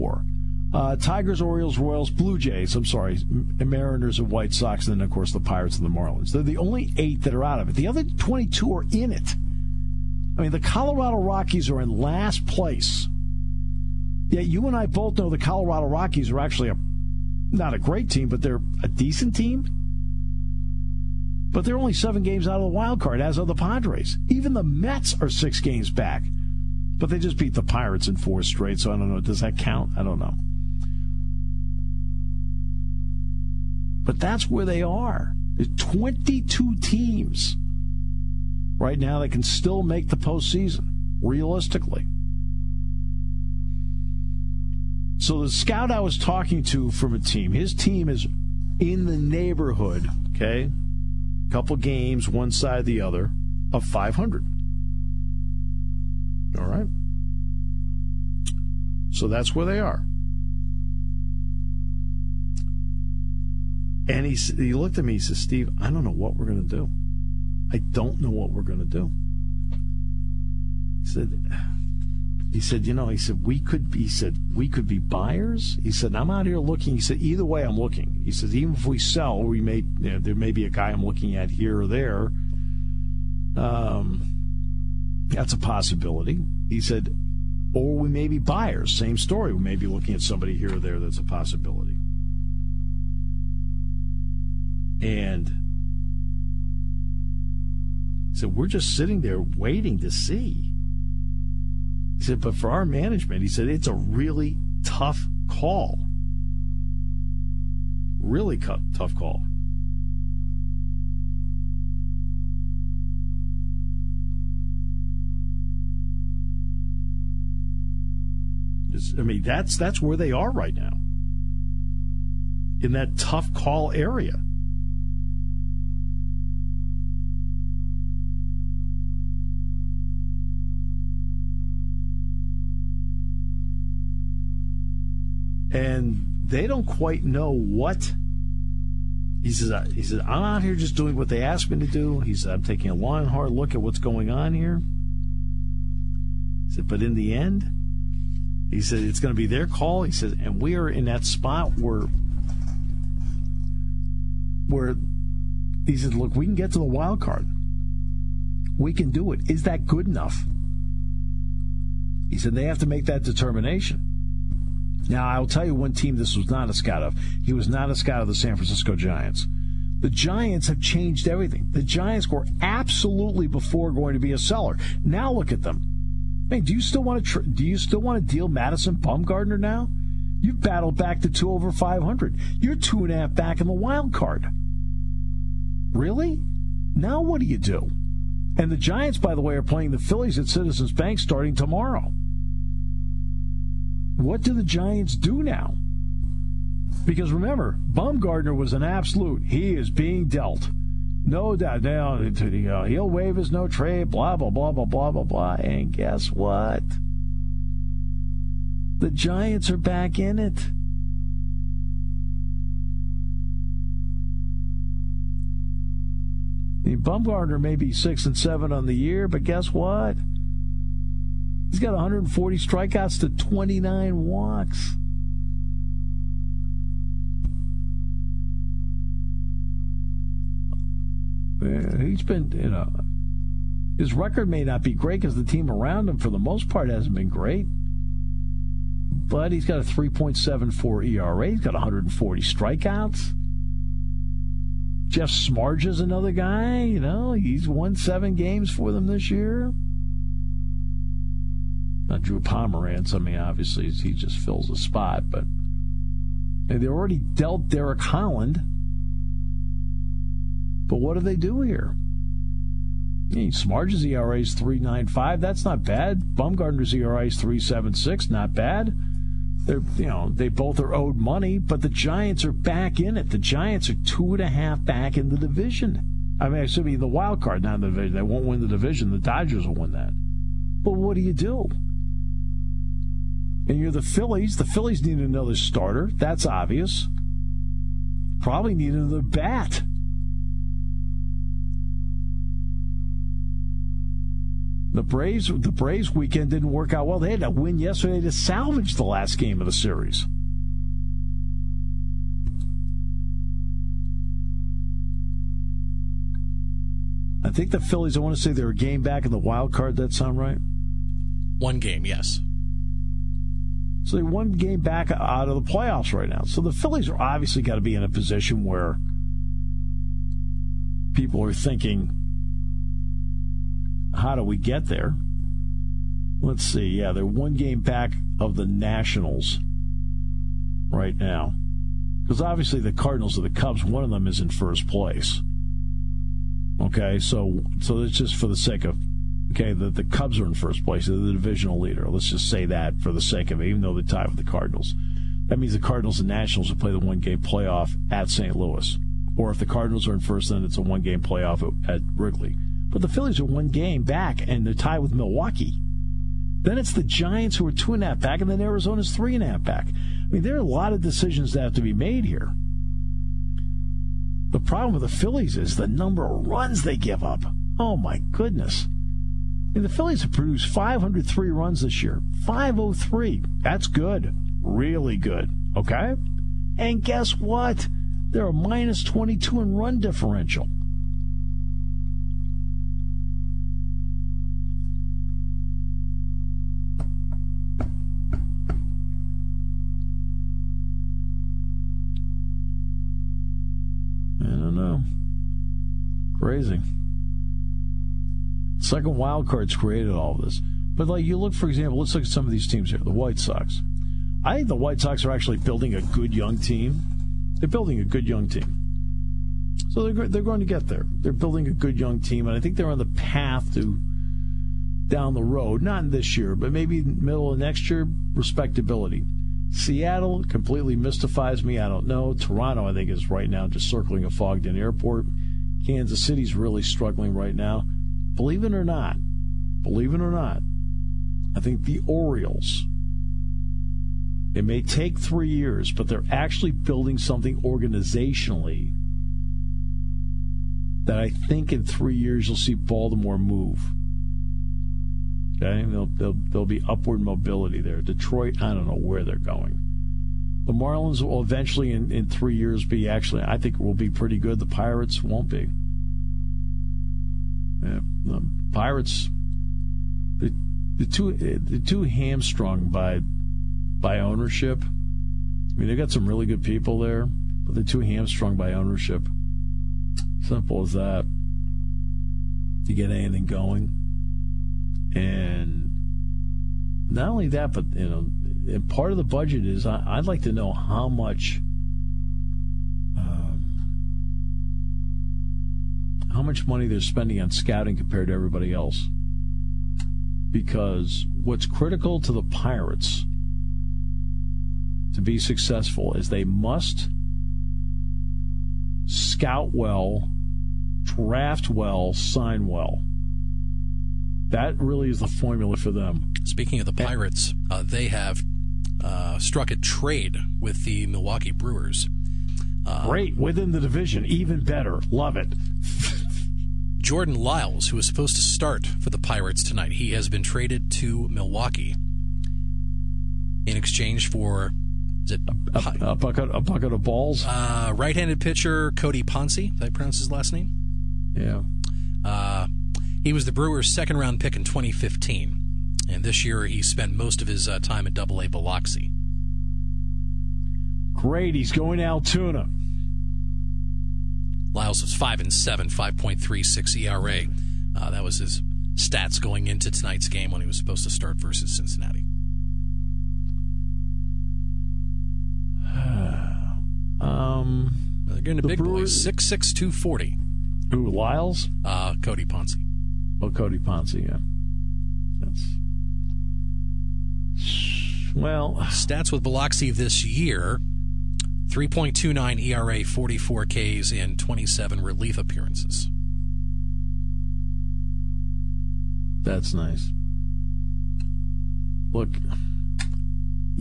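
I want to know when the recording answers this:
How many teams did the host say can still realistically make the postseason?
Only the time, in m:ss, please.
0:35.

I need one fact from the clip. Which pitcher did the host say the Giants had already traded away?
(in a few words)
Derek Holland.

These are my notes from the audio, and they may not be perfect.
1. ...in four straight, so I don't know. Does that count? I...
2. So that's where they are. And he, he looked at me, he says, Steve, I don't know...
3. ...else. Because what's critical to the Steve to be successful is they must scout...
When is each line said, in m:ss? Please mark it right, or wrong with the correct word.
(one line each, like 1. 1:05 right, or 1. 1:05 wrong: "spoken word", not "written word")
1. 0:28 right
2. 0:59 right
3. 8:08 wrong: "Pirates", not "Steve".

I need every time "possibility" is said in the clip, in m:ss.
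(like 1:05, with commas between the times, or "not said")
1:25, 1:31.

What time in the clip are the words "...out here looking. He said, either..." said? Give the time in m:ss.
1:16.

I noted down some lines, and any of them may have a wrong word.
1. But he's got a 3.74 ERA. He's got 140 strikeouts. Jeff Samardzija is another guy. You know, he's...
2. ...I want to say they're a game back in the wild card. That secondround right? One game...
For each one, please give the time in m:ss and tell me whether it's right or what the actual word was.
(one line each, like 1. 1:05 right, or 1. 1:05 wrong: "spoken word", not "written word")
1. 3:59 right
2. 5:08 wrong: "sound", not "secondround".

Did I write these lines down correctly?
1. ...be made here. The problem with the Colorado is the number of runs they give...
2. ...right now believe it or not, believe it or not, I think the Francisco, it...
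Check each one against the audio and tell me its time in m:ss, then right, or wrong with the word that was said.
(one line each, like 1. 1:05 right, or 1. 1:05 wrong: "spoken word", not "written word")
1. 6:01 wrong: "Phillies", not "Colorado"
2. 7:07 wrong: "Orioles", not "Francisco".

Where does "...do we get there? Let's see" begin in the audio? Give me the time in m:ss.
5:24.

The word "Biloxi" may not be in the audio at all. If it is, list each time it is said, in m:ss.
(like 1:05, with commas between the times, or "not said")
8:58, 9:29.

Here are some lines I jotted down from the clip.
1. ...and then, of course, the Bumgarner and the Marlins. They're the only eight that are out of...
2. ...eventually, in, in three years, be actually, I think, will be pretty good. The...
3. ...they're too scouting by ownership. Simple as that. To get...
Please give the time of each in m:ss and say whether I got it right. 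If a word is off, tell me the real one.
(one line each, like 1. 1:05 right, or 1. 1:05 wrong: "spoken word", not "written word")
1. 0:04 wrong: "Pirates", not "Bumgarner"
2. 7:31 right
3. 7:47 wrong: "hamstrung", not "scouting".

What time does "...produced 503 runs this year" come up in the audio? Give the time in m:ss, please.
6:10.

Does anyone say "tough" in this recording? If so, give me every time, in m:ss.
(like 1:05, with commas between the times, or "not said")
1:44, 1:48, 2:03.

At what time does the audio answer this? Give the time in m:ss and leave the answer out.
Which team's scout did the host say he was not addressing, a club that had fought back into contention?
2:48.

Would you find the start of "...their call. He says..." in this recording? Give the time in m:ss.
2:29.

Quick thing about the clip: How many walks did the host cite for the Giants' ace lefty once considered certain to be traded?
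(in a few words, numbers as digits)
29.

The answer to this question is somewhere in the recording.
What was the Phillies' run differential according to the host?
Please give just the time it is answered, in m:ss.
6:18.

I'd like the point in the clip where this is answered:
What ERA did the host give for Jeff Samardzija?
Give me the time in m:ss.
4:24.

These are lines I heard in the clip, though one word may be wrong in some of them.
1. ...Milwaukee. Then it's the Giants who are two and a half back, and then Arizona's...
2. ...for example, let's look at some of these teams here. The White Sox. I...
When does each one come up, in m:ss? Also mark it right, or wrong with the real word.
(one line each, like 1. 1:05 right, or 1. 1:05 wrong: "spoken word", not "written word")
1. 5:55 right
2. 6:41 right.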